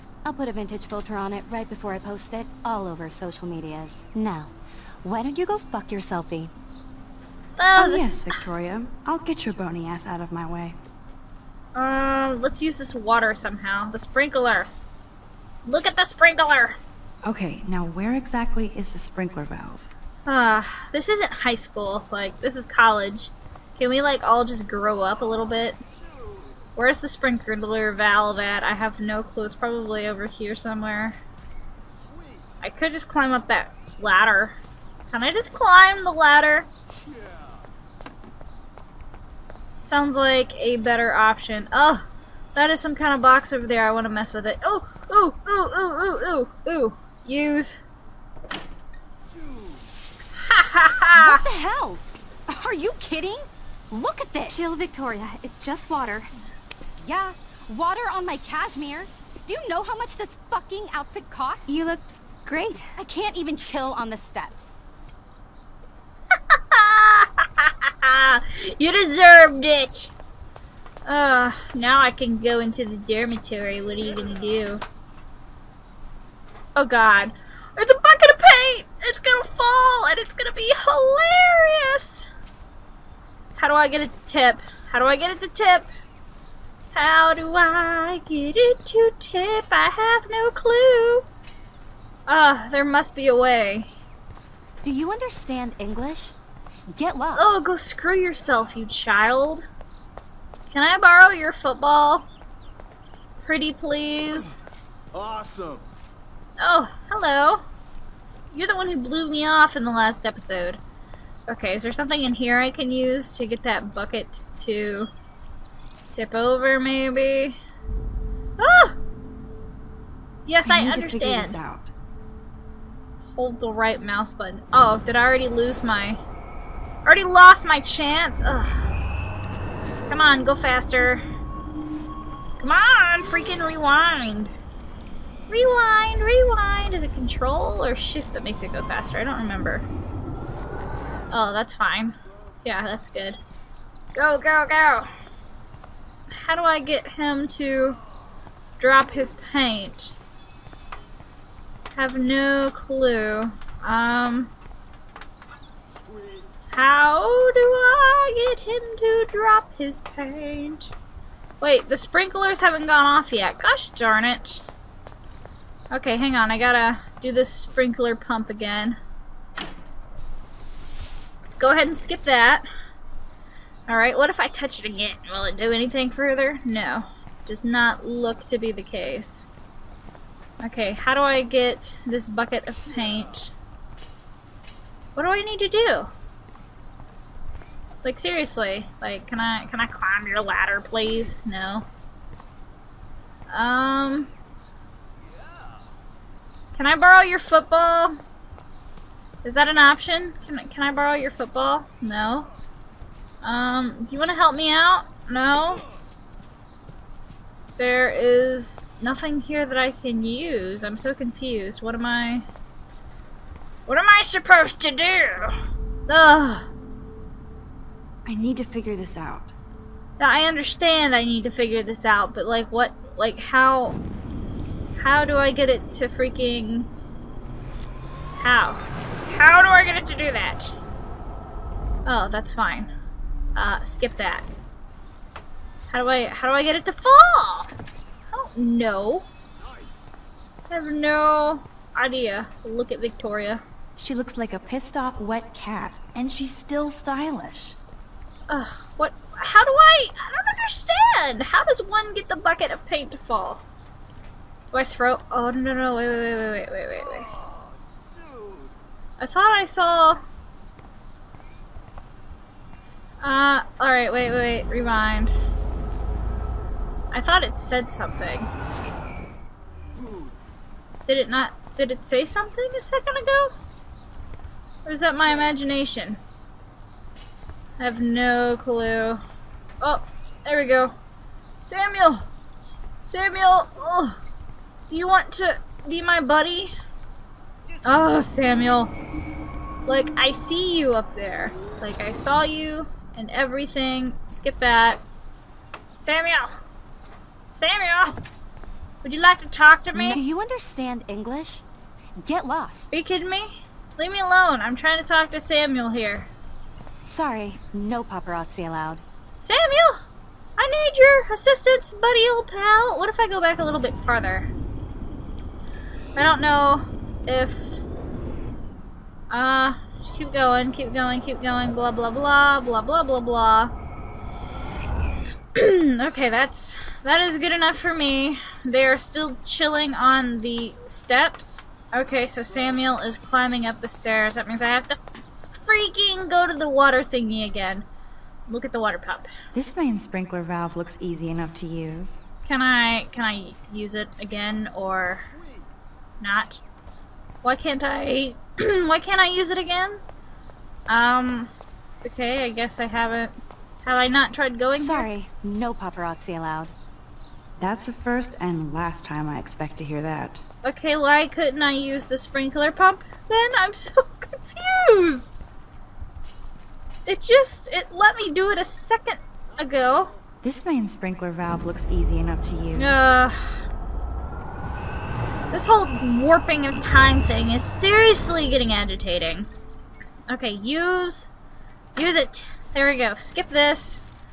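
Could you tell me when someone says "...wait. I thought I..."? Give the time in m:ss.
4:17.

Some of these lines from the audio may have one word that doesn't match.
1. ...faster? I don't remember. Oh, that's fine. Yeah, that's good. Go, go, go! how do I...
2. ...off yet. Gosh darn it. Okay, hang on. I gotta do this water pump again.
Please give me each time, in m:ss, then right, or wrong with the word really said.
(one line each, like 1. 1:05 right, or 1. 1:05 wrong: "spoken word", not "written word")
1. 2:18 right
2. 2:43 wrong: "sprinkler", not "water".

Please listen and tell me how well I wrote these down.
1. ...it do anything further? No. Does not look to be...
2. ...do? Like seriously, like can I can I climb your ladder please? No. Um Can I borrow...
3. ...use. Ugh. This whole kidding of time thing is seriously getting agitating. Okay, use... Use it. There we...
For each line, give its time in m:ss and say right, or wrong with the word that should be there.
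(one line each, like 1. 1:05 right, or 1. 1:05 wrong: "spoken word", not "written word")
1. 2:55 right
2. 3:05 right
3. 6:12 wrong: "warping", not "kidding".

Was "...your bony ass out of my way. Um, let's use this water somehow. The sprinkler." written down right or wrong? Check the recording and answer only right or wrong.
right.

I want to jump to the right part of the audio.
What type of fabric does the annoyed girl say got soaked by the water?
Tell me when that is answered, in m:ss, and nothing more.
0:58.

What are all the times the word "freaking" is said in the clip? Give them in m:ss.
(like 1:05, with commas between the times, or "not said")
2:13, 3:46, 5:35.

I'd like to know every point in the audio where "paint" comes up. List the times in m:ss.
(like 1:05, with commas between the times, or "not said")
1:18, 2:29, 2:39, 3:02, 4:12.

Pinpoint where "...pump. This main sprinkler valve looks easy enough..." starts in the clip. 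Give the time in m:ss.
5:38.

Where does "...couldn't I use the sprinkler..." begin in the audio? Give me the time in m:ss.
6:01.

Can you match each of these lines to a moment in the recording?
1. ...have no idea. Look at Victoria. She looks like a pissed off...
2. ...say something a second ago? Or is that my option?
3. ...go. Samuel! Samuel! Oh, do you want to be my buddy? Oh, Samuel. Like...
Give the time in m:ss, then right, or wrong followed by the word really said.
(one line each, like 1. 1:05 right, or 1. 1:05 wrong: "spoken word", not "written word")
1. 4:00 right
2. 4:32 wrong: "imagination", not "option"
3. 4:40 right.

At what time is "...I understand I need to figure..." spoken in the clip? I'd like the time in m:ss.
3:40.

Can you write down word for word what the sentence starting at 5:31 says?
Okay, so Samuel is climbing up the stairs.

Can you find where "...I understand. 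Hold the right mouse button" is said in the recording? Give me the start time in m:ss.
2:00.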